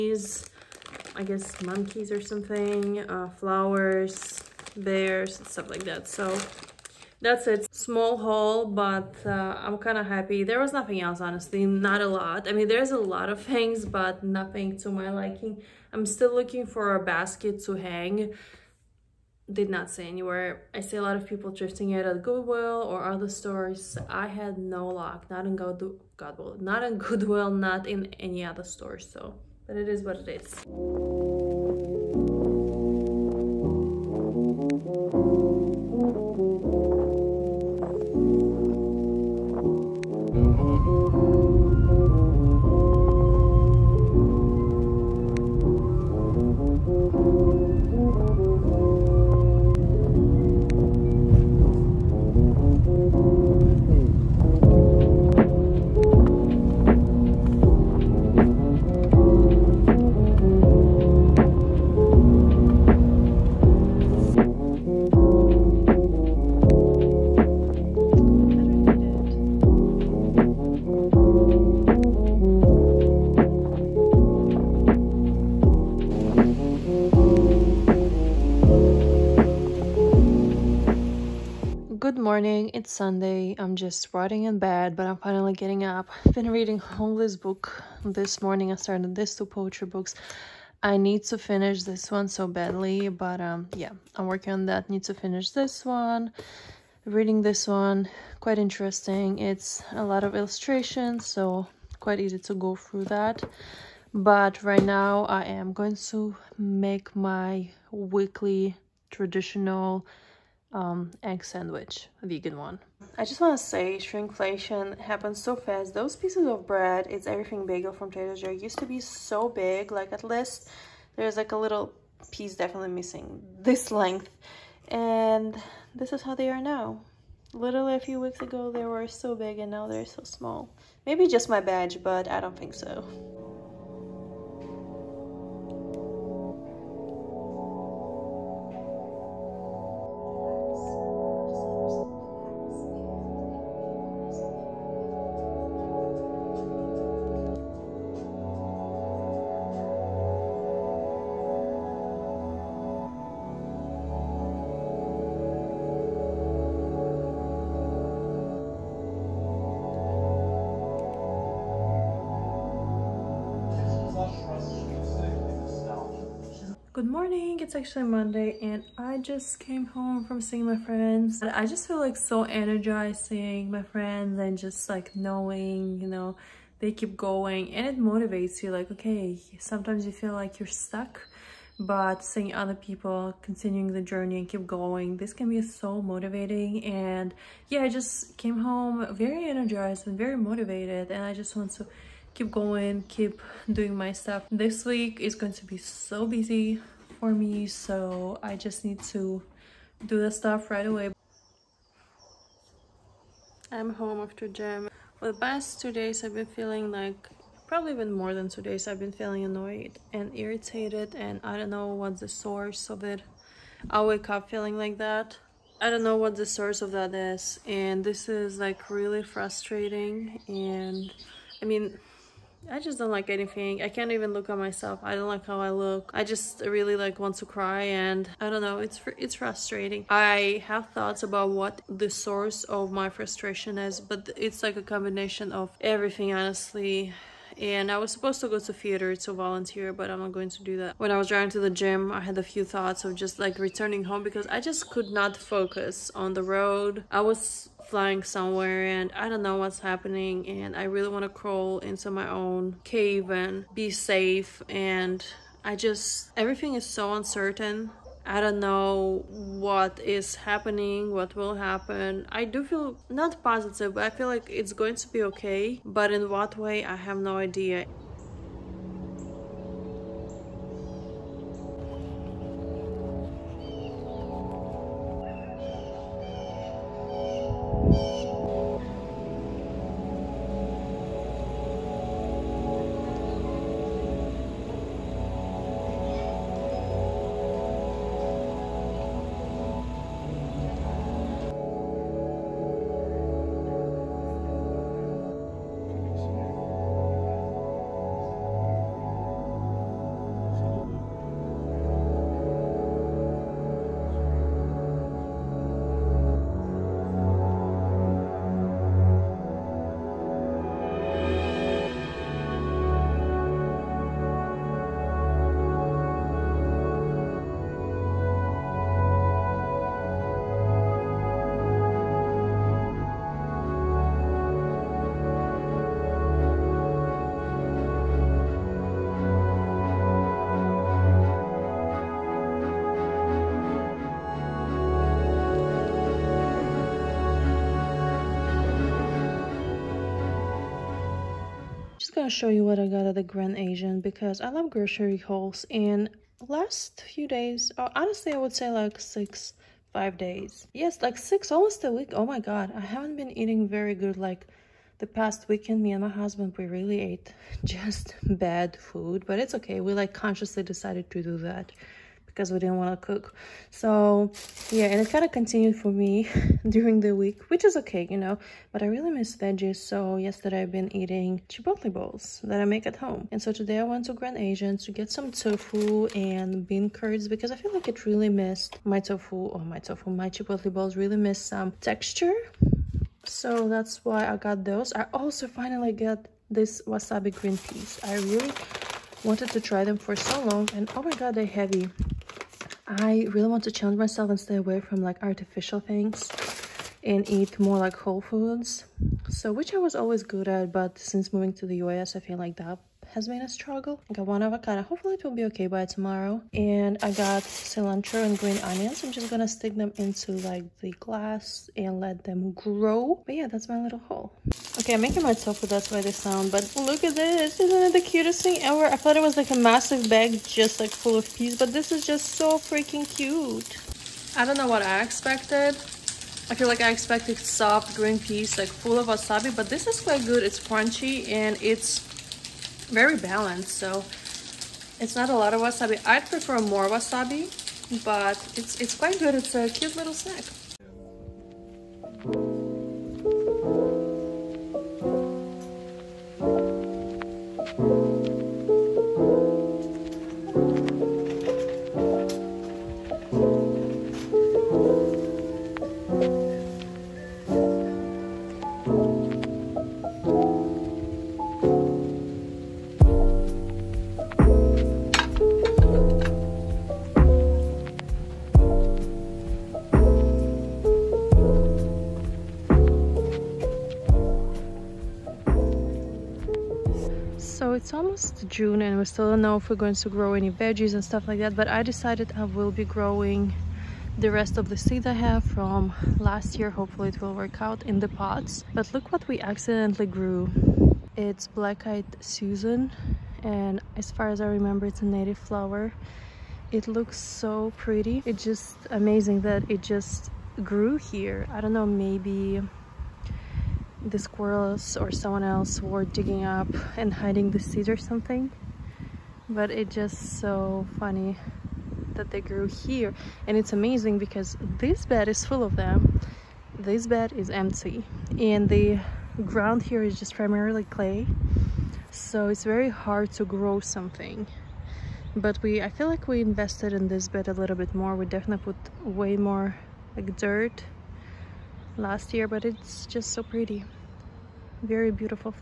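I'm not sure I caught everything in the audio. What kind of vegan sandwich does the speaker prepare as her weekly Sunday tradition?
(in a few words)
Egg sandwich.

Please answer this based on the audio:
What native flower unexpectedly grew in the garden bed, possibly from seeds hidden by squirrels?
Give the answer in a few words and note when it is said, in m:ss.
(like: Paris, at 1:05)
Black-eyed Susan, at 8:11.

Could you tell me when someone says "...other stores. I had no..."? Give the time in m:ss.
0:23.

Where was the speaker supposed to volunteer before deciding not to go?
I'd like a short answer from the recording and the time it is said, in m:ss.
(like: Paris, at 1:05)
Theater, at 3:58.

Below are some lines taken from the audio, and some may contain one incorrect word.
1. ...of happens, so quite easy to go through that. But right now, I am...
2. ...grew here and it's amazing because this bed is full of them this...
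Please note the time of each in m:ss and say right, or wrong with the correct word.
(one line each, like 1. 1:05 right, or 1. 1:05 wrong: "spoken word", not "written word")
1. 1:40 wrong: "illustrations", not "happens"
2. 8:32 right.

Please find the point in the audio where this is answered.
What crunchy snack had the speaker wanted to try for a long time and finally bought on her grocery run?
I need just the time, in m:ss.
6:26.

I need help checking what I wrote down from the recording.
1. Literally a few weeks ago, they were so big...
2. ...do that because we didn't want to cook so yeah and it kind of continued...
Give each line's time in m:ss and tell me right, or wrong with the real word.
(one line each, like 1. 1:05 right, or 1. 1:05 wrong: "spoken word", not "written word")
1. 2:07 right
2. 6:01 right.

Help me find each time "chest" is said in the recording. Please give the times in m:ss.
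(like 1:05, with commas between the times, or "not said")
not said.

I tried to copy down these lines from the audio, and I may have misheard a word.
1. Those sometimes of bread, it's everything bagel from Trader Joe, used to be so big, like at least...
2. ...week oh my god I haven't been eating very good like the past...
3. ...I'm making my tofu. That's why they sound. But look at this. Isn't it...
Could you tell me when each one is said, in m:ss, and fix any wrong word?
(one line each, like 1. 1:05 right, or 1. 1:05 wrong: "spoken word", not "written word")
1. 1:55 wrong: "pieces", not "sometimes"
2. 5:51 right
3. 6:54 right.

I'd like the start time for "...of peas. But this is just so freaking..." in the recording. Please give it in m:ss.
7:01.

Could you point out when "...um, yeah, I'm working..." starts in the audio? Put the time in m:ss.
1:33.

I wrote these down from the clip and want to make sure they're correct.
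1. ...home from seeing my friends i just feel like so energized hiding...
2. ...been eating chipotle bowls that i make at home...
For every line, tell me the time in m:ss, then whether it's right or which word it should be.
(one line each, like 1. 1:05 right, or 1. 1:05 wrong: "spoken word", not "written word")
1. 2:49 wrong: "seeing", not "hiding"
2. 6:10 right.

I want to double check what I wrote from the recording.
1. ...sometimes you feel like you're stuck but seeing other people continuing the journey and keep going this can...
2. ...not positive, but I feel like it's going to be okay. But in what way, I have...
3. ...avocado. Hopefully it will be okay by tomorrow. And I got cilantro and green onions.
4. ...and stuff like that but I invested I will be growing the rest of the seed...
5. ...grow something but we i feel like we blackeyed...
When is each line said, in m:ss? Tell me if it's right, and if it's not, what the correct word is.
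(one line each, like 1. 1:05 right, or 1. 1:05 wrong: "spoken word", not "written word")
1. 2:59 right
2. 4:23 right
3. 6:44 right
4. 8:00 wrong: "decided", not "invested"
5. 8:43 wrong: "invested", not "blackeyed".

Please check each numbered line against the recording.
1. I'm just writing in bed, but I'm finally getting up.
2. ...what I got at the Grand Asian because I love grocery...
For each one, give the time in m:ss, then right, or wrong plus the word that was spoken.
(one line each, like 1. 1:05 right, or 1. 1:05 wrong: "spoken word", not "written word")
1. 1:23 right
2. 5:42 right.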